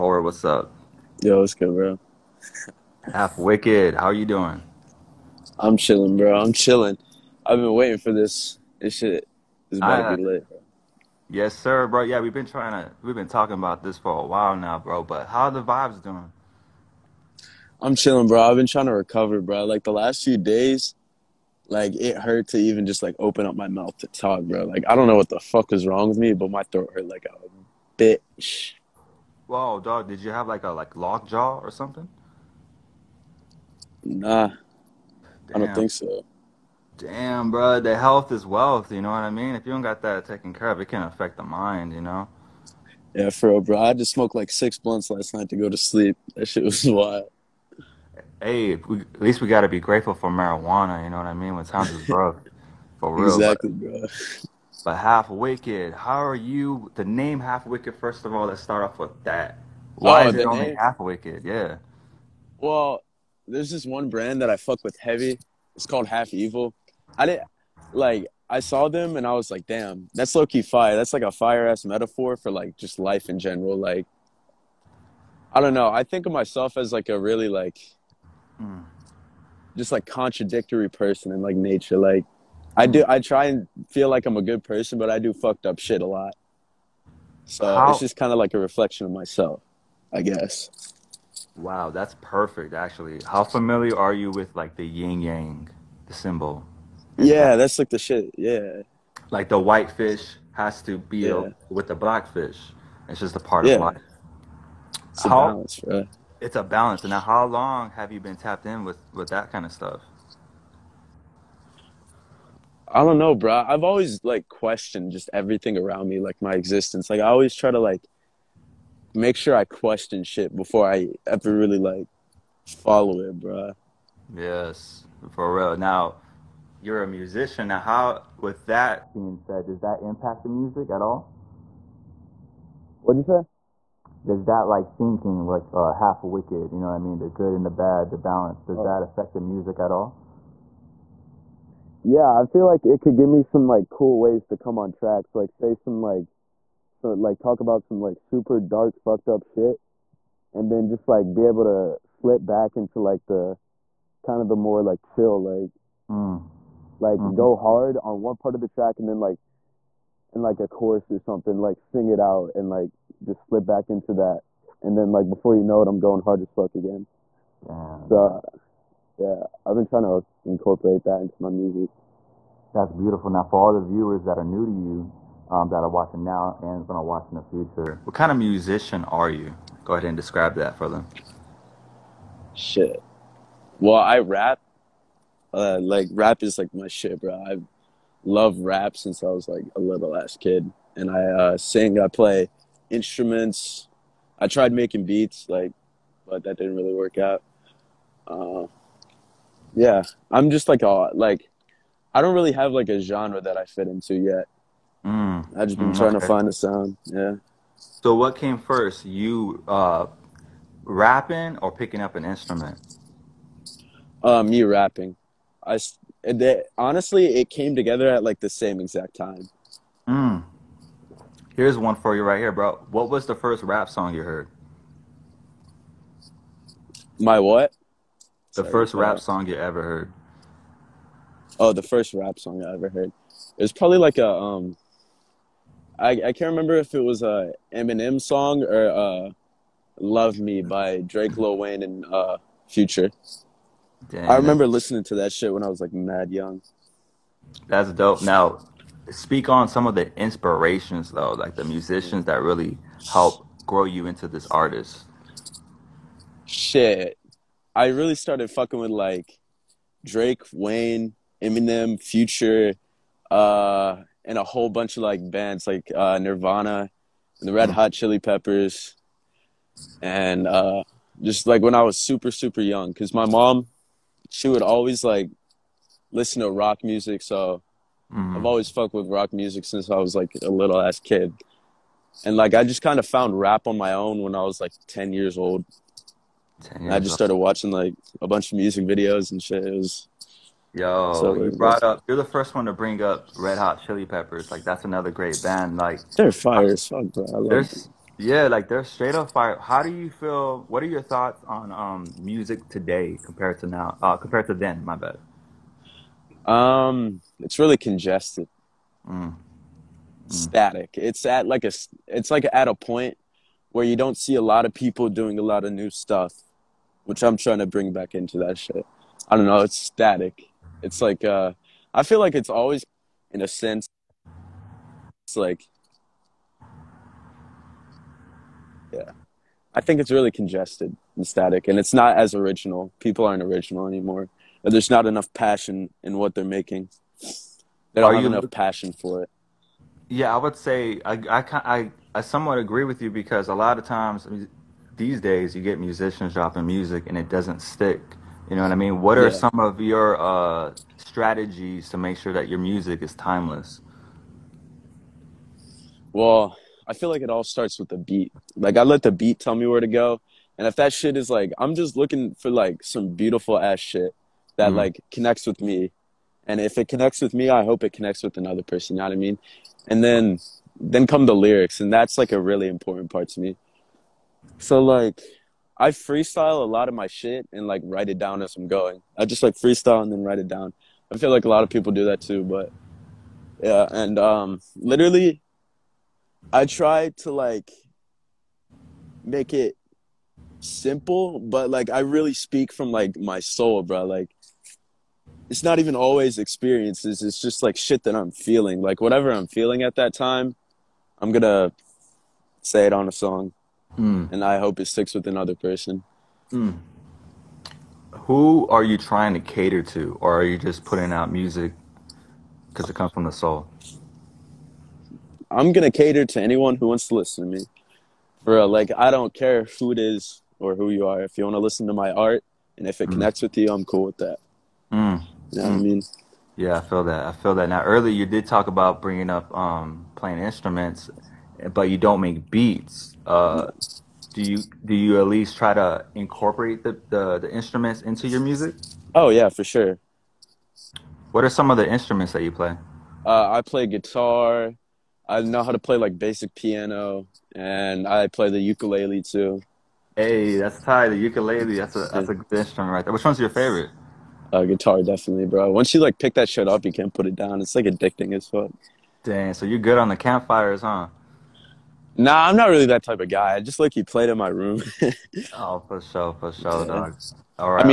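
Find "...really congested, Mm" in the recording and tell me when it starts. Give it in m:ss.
5:07.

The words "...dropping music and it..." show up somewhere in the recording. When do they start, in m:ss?
5:46.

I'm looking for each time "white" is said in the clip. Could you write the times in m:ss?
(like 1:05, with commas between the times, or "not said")
1:39.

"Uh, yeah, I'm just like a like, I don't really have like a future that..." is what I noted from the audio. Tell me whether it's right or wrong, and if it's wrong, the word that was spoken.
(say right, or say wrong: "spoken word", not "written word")
wrong: "genre", not "future".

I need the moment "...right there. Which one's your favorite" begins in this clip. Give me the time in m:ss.
7:32.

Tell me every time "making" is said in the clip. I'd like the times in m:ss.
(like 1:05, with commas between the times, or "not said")
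3:14, 5:36.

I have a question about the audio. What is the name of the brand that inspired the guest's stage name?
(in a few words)
Half Evil.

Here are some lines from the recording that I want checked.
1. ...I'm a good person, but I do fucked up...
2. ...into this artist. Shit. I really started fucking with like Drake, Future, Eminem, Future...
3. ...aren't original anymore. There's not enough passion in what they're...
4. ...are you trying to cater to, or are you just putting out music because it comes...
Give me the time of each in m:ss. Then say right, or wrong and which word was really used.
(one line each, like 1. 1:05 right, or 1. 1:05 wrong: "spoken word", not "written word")
1. 1:24 right
2. 4:14 wrong: "Wayne", not "Future"
3. 5:33 right
4. 6:48 right.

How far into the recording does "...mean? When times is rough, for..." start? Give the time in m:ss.
0:51.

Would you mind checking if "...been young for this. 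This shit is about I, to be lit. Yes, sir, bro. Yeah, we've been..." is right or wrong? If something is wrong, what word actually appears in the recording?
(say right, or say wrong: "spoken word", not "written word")
wrong: "waiting", not "young".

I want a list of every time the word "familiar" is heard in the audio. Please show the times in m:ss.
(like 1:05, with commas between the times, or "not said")
1:33.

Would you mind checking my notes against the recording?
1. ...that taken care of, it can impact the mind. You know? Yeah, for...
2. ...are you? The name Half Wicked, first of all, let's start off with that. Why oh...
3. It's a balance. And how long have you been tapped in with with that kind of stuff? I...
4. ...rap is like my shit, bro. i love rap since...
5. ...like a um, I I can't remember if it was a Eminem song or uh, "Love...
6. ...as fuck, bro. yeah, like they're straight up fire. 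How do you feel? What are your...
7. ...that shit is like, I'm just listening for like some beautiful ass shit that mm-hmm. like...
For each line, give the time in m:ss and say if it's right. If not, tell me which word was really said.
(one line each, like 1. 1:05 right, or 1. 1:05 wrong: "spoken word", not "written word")
1. 0:40 wrong: "affect", not "impact"
2. 0:56 right
3. 1:46 right
4. 3:06 right
5. 3:53 right
6. 4:56 right
7. 6:00 wrong: "looking", not "listening".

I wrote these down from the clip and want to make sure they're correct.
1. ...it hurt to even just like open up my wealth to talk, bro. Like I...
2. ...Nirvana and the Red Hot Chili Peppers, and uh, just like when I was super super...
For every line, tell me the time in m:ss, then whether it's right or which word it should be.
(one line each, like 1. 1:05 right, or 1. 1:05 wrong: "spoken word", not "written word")
1. 0:21 wrong: "mouth", not "wealth"
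2. 4:26 right.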